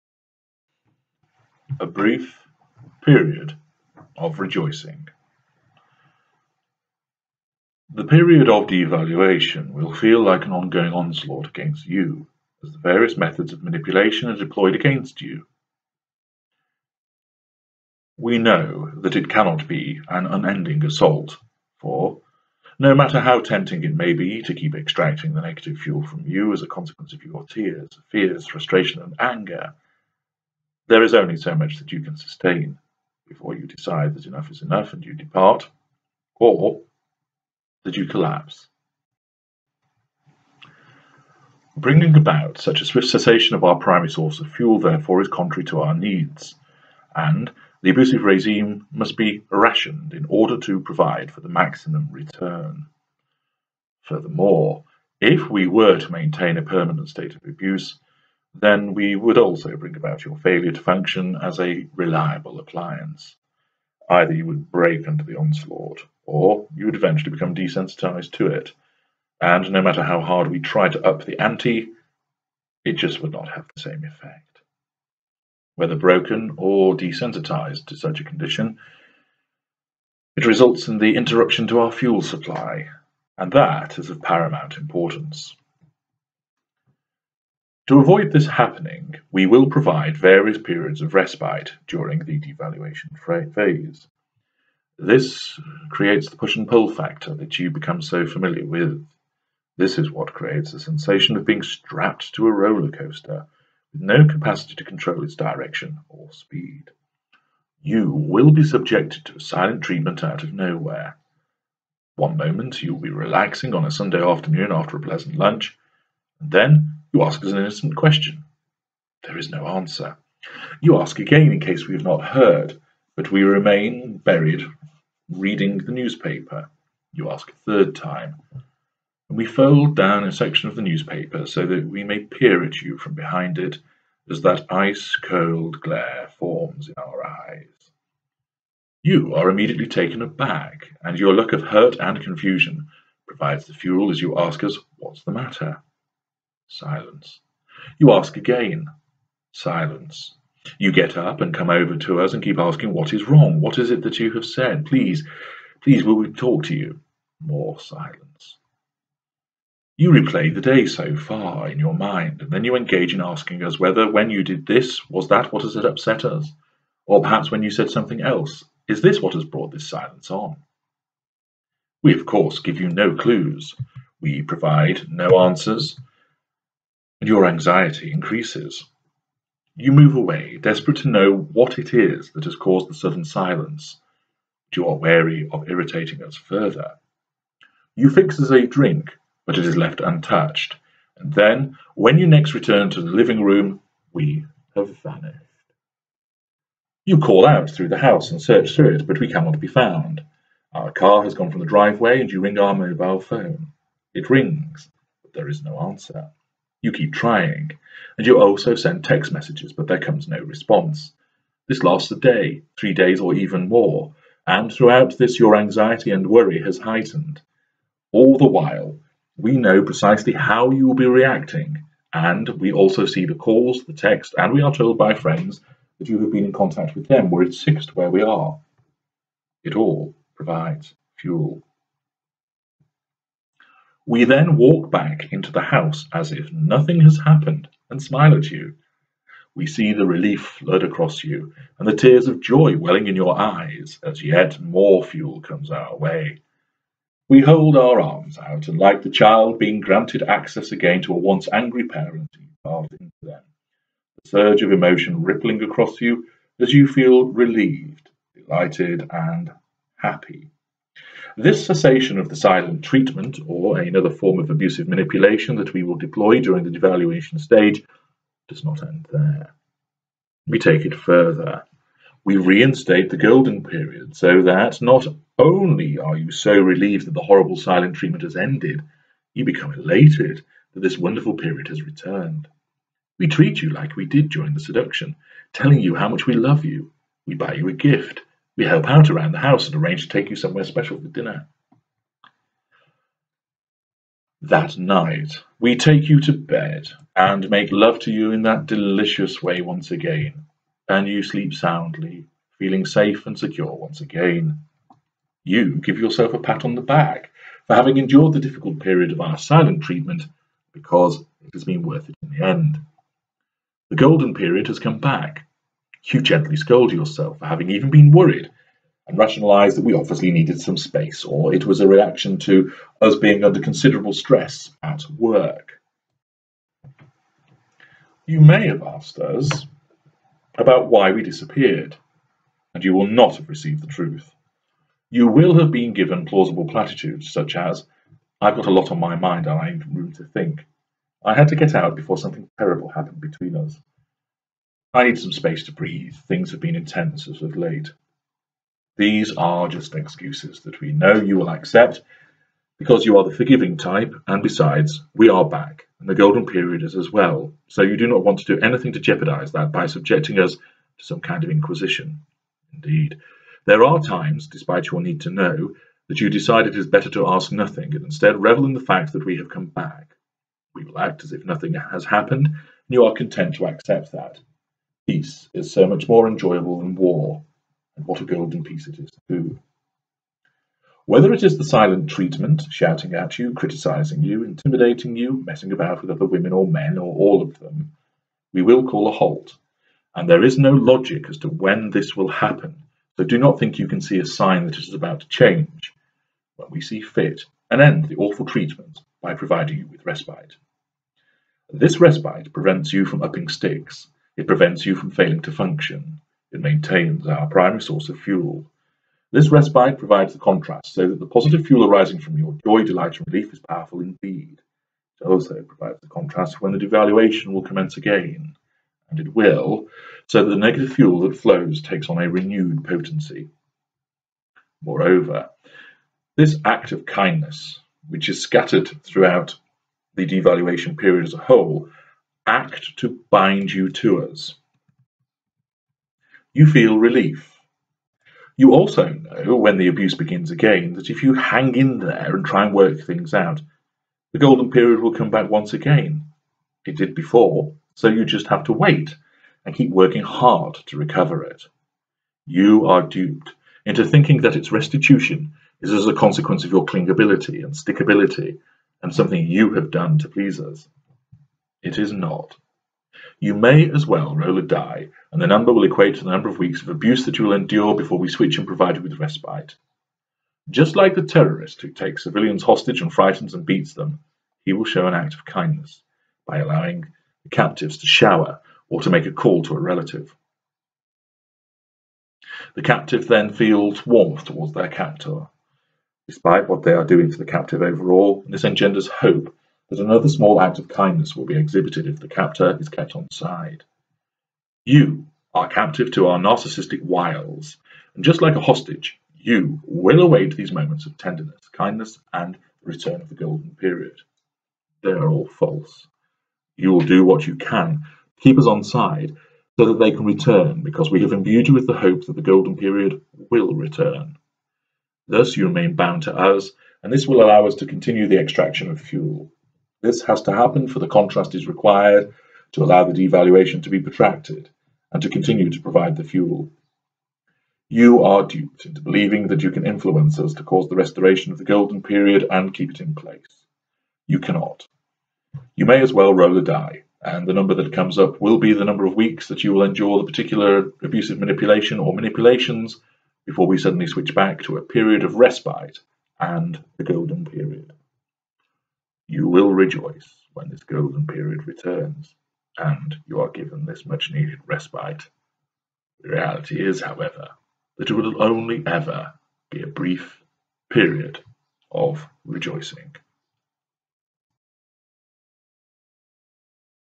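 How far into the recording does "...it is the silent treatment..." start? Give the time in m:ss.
6:21.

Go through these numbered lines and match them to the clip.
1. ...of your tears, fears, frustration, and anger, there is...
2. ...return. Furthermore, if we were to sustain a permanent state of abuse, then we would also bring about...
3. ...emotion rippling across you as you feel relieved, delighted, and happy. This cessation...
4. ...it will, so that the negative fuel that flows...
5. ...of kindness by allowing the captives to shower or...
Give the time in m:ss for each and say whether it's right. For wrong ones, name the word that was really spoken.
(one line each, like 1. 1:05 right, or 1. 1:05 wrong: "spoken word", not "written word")
1. 0:27 right
2. 0:52 wrong: "maintain", not "sustain"
3. 4:14 right
4. 6:59 right
5. 7:55 right.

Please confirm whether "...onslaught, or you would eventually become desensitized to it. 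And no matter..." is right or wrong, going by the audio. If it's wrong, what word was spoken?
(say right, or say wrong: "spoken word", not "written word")
right.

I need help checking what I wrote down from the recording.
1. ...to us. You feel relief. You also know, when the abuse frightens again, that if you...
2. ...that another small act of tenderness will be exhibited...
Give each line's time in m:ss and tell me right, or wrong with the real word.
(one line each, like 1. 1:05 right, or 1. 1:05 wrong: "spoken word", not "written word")
1. 7:13 wrong: "begins", not "frightens"
2. 8:09 wrong: "kindness", not "tenderness".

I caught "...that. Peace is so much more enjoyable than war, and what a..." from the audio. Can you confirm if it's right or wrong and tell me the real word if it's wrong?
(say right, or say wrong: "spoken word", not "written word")
right.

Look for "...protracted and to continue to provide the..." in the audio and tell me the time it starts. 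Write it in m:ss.
8:43.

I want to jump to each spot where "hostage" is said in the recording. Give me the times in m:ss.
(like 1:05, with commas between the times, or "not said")
7:52, 8:18.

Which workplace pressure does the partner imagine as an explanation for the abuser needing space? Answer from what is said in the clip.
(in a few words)
stress at work.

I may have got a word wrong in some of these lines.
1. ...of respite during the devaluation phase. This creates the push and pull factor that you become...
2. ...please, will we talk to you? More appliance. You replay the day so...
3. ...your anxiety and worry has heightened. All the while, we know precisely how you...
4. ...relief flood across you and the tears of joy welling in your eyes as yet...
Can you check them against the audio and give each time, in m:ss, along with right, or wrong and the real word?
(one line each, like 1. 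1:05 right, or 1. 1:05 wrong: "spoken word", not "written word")
1. 1:31 right
2. 2:35 wrong: "silence", not "appliance"
3. 3:35 right
4. 4:00 right.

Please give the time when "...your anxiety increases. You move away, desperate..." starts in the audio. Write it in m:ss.
2:57.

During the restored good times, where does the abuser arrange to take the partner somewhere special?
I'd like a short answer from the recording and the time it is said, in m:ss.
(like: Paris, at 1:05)
dinner, at 4:51.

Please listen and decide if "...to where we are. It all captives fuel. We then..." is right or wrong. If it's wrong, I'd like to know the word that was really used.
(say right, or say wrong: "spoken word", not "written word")
wrong: "provides", not "captives".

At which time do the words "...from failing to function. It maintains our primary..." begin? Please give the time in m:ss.
6:44.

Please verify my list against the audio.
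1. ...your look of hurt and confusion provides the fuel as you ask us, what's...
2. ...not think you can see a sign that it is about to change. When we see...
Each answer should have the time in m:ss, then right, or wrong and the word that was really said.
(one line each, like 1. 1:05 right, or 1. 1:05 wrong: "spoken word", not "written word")
1. 2:21 right
2. 6:33 right.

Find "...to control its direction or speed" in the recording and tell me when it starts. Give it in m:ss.
1:44.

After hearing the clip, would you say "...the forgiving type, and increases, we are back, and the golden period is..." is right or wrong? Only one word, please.
wrong.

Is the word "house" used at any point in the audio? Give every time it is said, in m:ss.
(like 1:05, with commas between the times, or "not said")
3:17, 3:55, 4:49.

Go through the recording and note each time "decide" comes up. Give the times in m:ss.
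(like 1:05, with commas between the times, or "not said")
0:33, 6:06.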